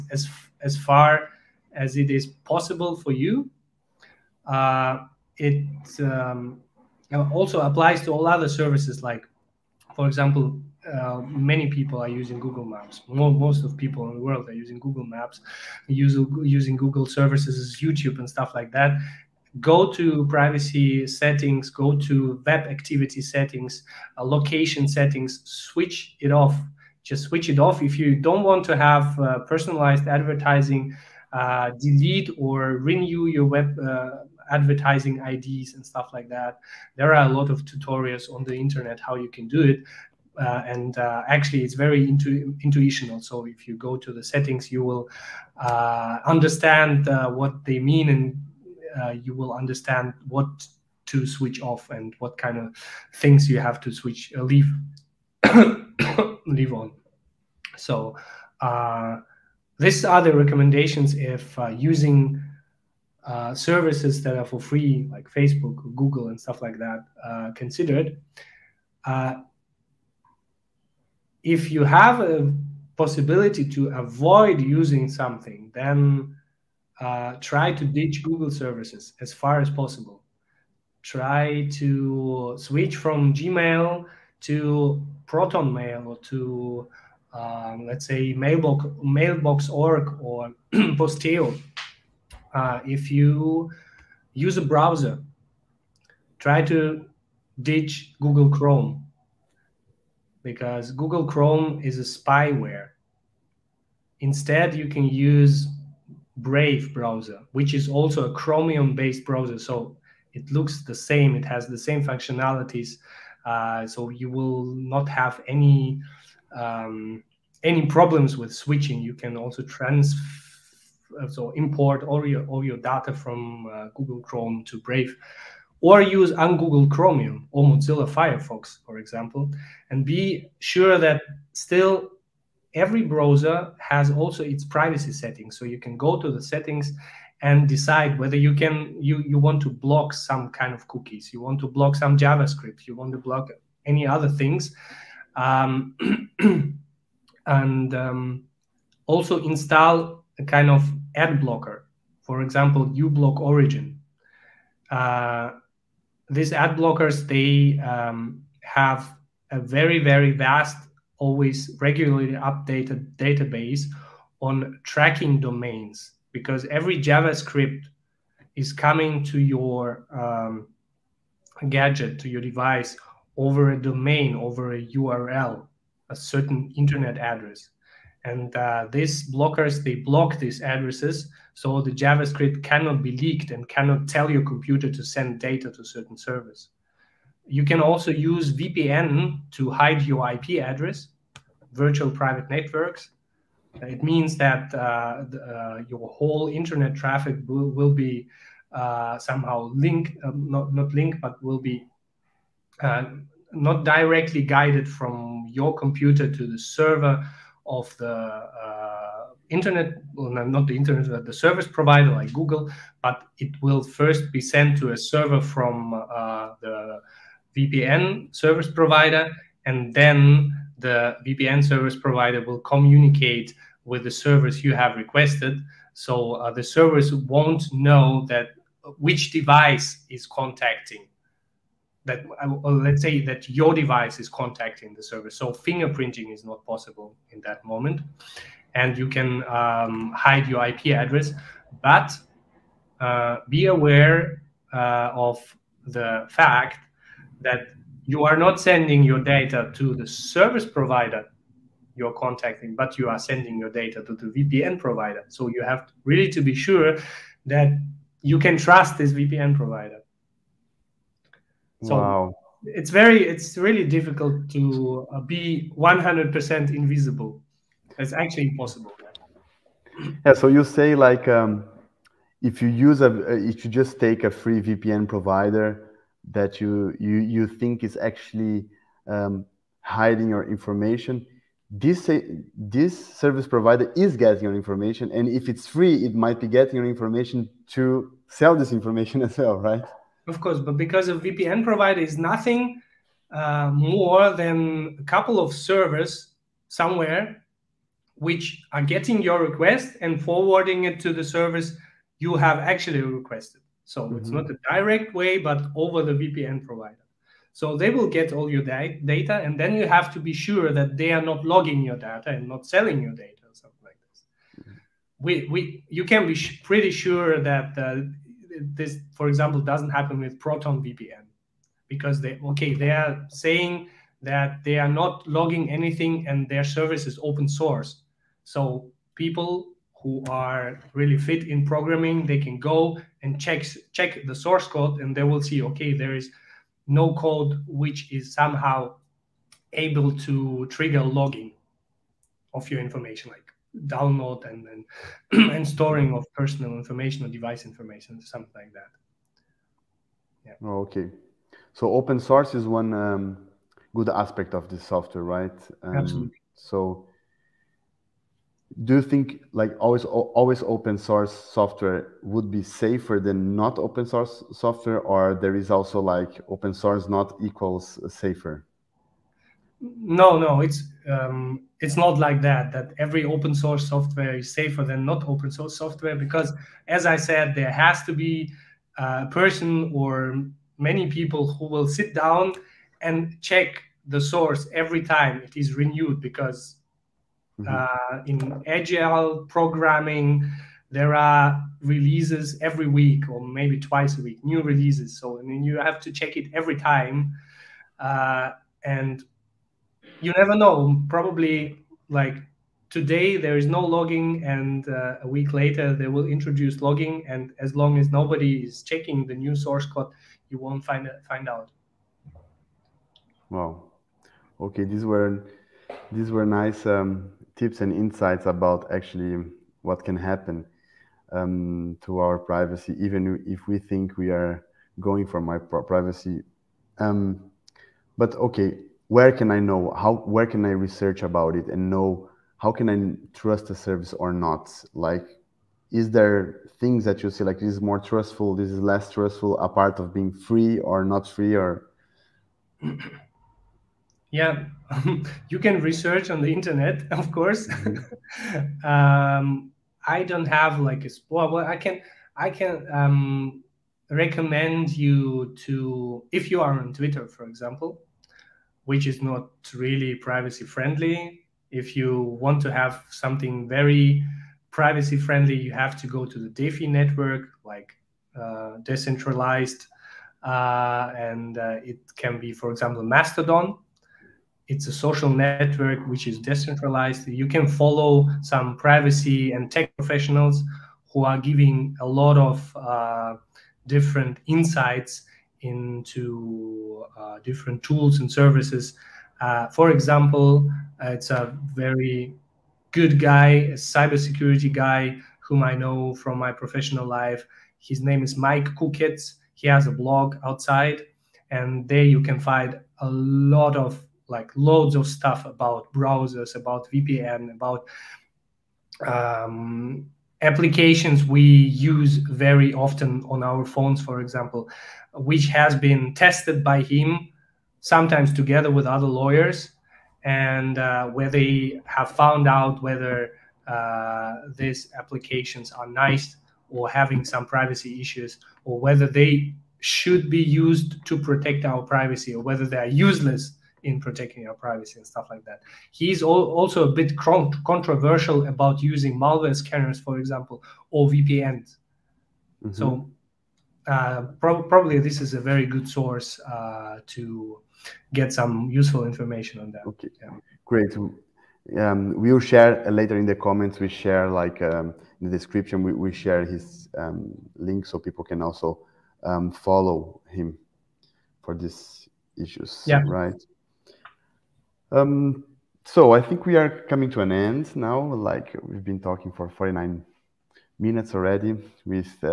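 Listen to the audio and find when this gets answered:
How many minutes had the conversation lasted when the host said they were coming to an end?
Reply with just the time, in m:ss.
9:29.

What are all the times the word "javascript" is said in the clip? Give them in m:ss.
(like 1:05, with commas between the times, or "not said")
2:22, 2:46, 3:01.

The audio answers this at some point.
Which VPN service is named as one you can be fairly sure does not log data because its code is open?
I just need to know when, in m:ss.
5:20.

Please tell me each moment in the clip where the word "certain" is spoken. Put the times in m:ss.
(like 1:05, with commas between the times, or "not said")
2:56, 3:05.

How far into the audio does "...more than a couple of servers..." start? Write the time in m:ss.
4:53.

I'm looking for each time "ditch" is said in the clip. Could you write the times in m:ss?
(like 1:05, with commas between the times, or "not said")
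1:17, 1:37.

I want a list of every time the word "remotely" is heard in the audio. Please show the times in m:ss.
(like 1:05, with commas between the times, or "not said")
not said.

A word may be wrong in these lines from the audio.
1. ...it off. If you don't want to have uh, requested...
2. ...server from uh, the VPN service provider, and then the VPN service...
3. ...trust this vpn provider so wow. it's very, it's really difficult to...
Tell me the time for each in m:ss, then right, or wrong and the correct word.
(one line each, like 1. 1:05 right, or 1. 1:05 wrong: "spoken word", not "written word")
1. 0:27 wrong: "personalized", not "requested"
2. 3:34 right
3. 4:18 right.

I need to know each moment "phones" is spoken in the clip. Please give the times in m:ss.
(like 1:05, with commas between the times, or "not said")
8:33.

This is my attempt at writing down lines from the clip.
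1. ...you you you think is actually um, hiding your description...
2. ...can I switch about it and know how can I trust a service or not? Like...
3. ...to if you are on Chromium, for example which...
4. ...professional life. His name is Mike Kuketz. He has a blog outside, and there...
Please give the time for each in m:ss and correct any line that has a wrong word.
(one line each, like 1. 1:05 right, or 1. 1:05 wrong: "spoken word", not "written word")
1. 4:36 wrong: "information", not "description"
2. 7:10 wrong: "research", not "switch"
3. 7:35 wrong: "Twitter", not "Chromium"
4. 8:16 right.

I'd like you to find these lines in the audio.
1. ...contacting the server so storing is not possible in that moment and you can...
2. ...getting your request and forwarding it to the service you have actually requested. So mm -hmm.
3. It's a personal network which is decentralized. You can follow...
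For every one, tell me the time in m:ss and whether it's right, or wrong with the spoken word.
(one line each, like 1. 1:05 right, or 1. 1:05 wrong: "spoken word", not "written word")
1. 3:54 wrong: "fingerprinting", not "storing"
2. 4:58 right
3. 7:54 wrong: "social", not "personal".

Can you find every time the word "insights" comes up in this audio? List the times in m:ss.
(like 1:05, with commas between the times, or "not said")
6:57, 8:04.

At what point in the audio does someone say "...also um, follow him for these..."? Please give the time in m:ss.
9:18.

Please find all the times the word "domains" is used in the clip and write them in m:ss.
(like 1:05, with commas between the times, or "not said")
2:45, 2:53.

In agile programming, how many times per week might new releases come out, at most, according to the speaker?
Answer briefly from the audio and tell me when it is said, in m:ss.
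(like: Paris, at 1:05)
twice, at 6:33.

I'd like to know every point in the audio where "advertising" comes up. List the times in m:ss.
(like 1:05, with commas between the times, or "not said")
0:30, 0:34.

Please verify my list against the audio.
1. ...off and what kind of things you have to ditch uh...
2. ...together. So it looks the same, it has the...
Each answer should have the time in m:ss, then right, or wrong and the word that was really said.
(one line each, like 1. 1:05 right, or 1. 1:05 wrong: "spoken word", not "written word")
1. 0:51 wrong: "switch", not "ditch"
2. 1:49 wrong: "browser", not "together".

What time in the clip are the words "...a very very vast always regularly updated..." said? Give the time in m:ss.
2:39.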